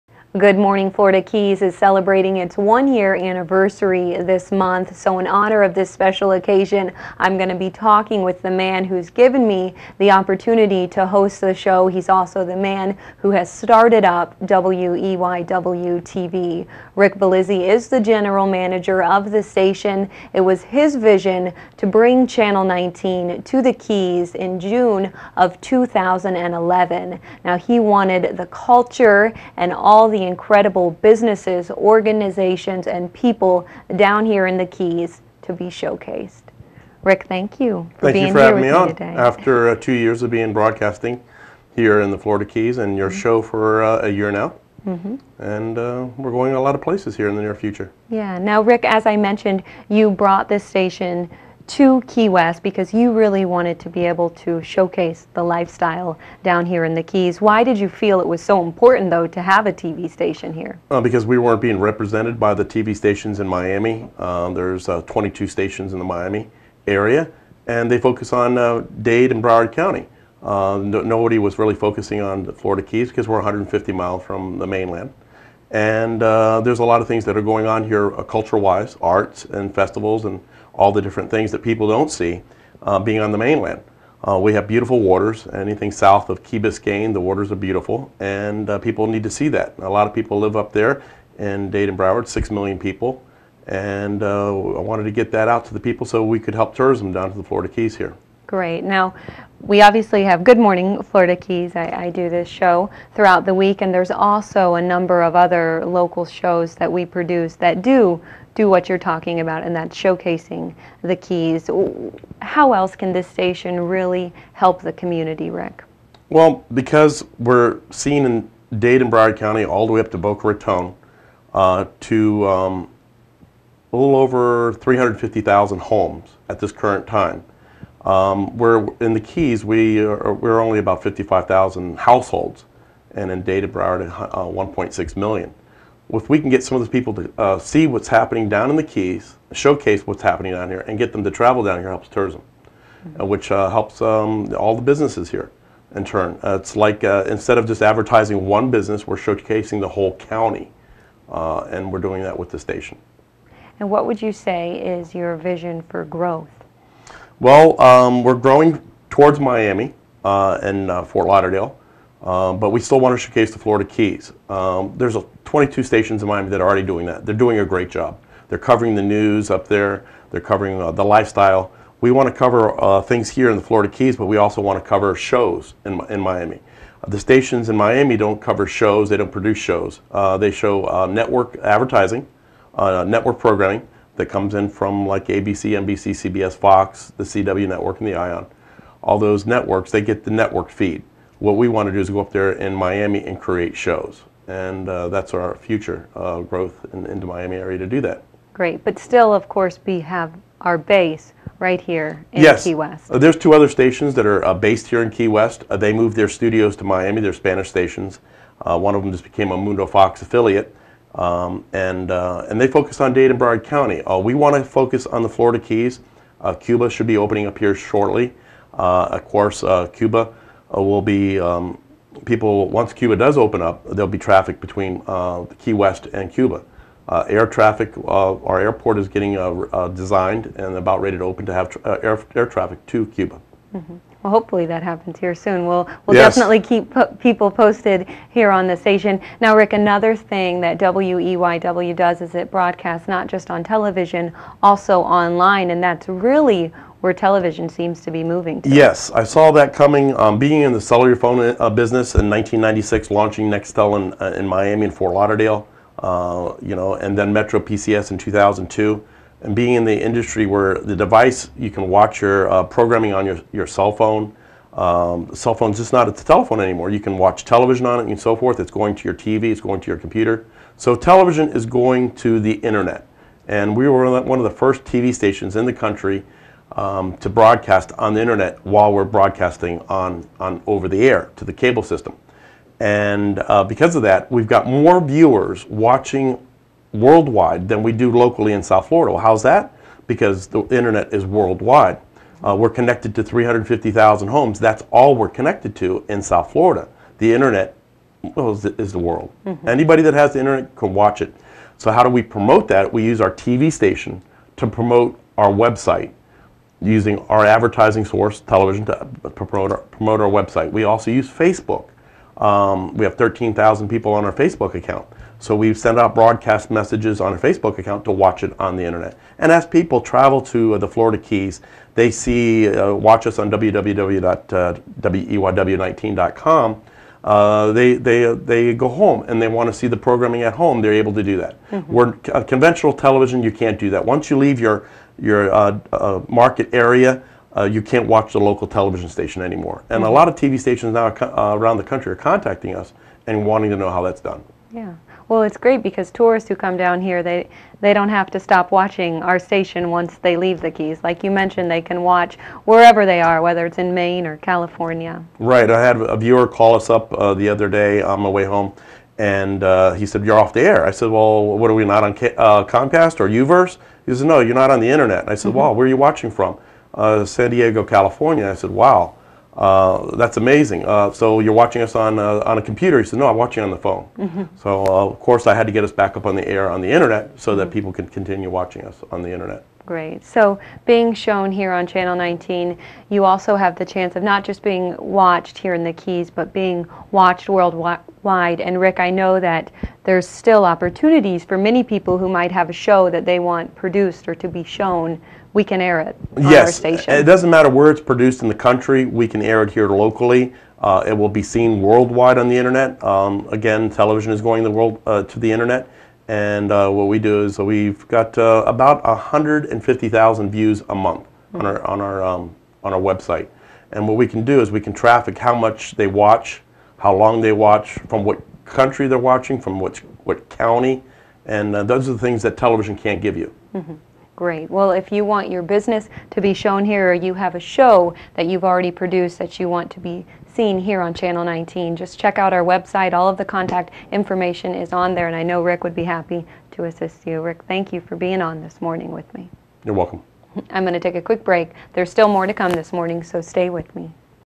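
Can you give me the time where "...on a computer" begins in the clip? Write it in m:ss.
6:12.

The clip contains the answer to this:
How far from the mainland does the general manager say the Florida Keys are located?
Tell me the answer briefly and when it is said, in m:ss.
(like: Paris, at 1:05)
150 miles, at 1:13.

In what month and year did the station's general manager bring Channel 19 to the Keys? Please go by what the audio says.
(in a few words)
June 2011.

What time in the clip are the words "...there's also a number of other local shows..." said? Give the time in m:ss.
1:43.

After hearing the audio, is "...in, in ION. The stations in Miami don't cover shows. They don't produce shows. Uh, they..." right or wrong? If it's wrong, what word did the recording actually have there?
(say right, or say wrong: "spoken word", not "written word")
wrong: "Miami", not "ION".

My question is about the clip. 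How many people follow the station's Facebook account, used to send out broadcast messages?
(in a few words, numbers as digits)
13,000.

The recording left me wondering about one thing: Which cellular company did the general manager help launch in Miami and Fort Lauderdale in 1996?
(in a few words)
Nextel.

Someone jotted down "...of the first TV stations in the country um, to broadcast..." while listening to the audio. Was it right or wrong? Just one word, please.
right.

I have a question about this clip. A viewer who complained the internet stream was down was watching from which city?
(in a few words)
San Diego.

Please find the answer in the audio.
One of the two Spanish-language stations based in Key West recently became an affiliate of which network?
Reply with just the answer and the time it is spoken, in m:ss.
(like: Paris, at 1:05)
Mundo Fox, at 3:29.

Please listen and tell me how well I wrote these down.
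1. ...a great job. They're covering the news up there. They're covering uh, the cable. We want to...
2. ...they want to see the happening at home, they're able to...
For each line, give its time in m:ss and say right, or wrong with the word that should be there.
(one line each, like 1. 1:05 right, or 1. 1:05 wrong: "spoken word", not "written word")
1. 2:47 wrong: "lifestyle", not "cable"
2. 5:29 wrong: "programming", not "happening".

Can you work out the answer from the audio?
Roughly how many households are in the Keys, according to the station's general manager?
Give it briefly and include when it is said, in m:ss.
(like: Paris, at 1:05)
55,000, at 2:11.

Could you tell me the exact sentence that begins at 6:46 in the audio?
And uh, what we do is we've got uh, about 150,000 views a month mm-hmm.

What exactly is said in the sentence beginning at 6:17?
people could continue watching us on the Internet.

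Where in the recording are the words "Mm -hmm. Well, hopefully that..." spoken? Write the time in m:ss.
3:53.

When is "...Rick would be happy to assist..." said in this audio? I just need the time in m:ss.
7:15.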